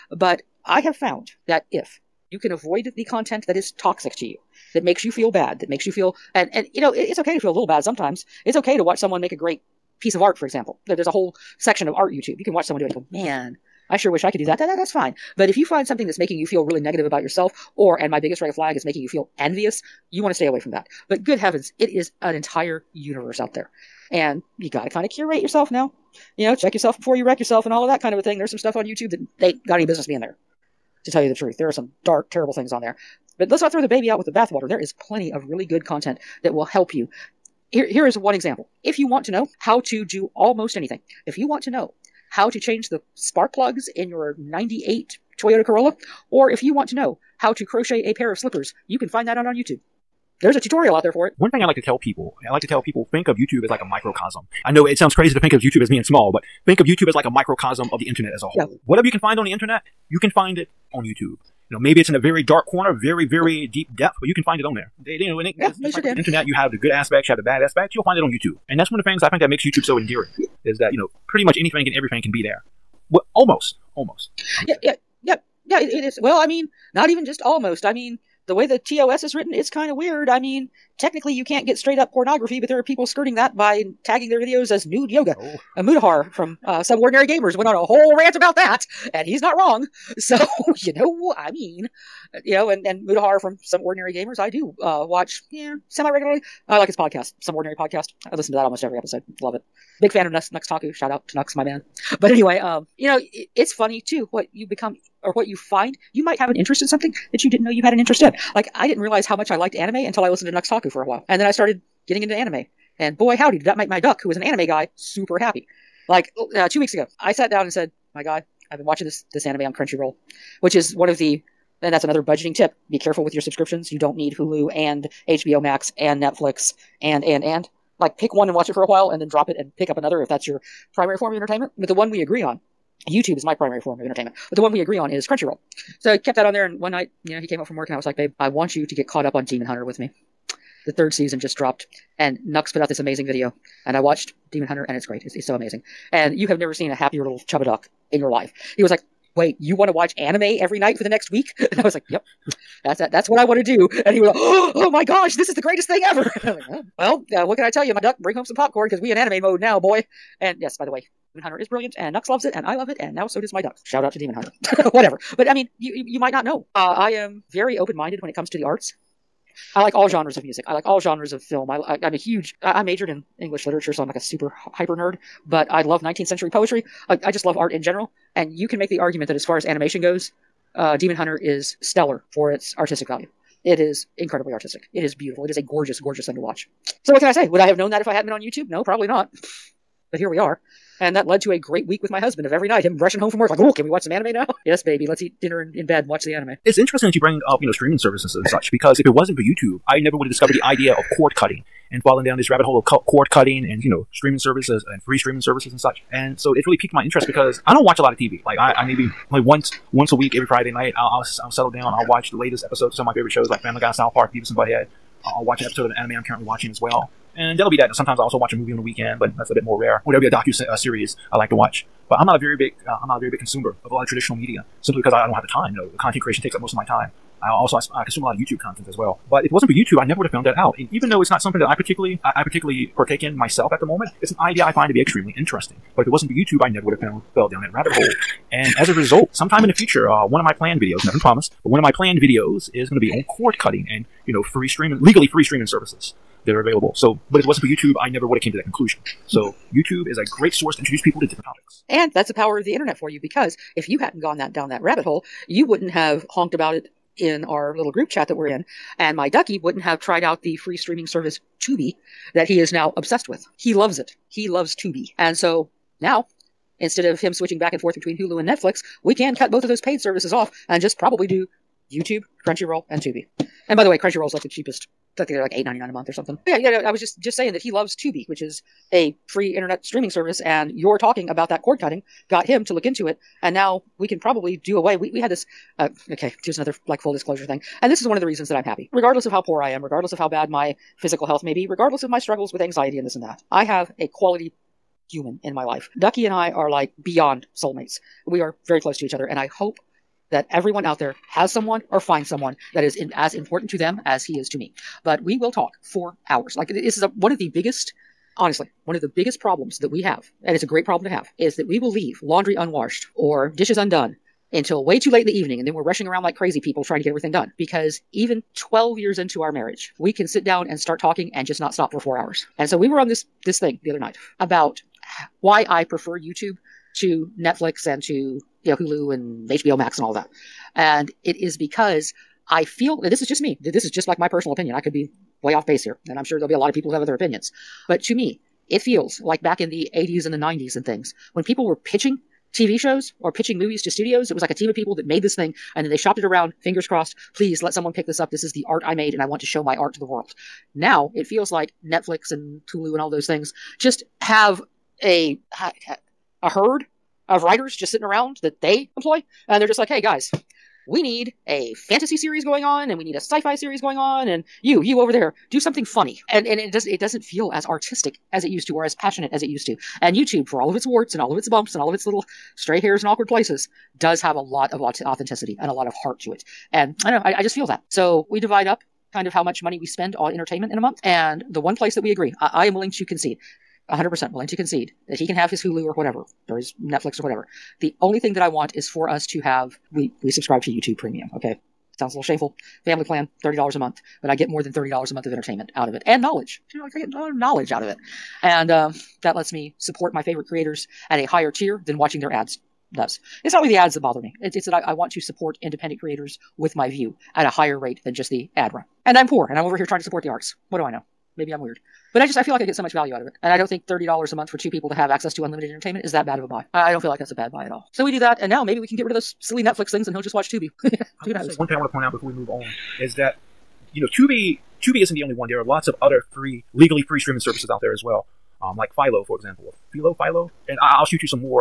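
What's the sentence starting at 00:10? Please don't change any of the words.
There, there's a whole section of art YouTube.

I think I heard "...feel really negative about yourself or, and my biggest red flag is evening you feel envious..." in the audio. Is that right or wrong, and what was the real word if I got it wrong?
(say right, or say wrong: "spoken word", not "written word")
wrong: "making", not "evening".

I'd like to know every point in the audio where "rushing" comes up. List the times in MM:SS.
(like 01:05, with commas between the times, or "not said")
03:12, 05:15.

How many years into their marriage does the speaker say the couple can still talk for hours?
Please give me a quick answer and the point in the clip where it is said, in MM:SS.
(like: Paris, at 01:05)
12, at 05:18.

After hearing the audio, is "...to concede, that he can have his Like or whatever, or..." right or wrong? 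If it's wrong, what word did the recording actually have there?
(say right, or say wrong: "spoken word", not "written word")
wrong: "Hulu", not "Like".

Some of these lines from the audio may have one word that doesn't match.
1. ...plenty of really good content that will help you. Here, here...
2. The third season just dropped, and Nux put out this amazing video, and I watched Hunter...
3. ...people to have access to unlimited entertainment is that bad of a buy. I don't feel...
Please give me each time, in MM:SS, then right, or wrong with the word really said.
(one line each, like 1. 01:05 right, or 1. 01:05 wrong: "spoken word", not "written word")
1. 00:34 right
2. 02:20 wrong: "Demon", not "Hunter"
3. 06:54 right.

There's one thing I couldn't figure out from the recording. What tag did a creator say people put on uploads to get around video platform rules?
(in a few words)
nude yoga.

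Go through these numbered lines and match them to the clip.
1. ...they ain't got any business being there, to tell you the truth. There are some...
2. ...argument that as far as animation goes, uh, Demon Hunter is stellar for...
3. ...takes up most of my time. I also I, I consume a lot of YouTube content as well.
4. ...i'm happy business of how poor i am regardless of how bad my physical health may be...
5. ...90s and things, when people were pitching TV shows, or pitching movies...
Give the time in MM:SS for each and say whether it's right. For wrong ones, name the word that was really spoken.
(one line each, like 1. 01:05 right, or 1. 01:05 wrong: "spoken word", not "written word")
1. 00:29 right
2. 02:58 right
3. 03:46 right
4. 04:48 wrong: "regardless", not "business"
5. 05:40 right.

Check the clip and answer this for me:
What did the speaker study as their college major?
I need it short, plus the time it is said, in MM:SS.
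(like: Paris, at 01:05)
English literature, at 02:53.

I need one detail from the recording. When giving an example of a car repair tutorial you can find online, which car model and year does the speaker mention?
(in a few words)
98 Toyota Corolla.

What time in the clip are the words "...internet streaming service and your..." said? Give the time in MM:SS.
04:39.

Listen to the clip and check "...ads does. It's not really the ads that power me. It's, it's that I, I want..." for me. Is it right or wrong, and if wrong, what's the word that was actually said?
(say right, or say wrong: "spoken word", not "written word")
wrong: "bother", not "power".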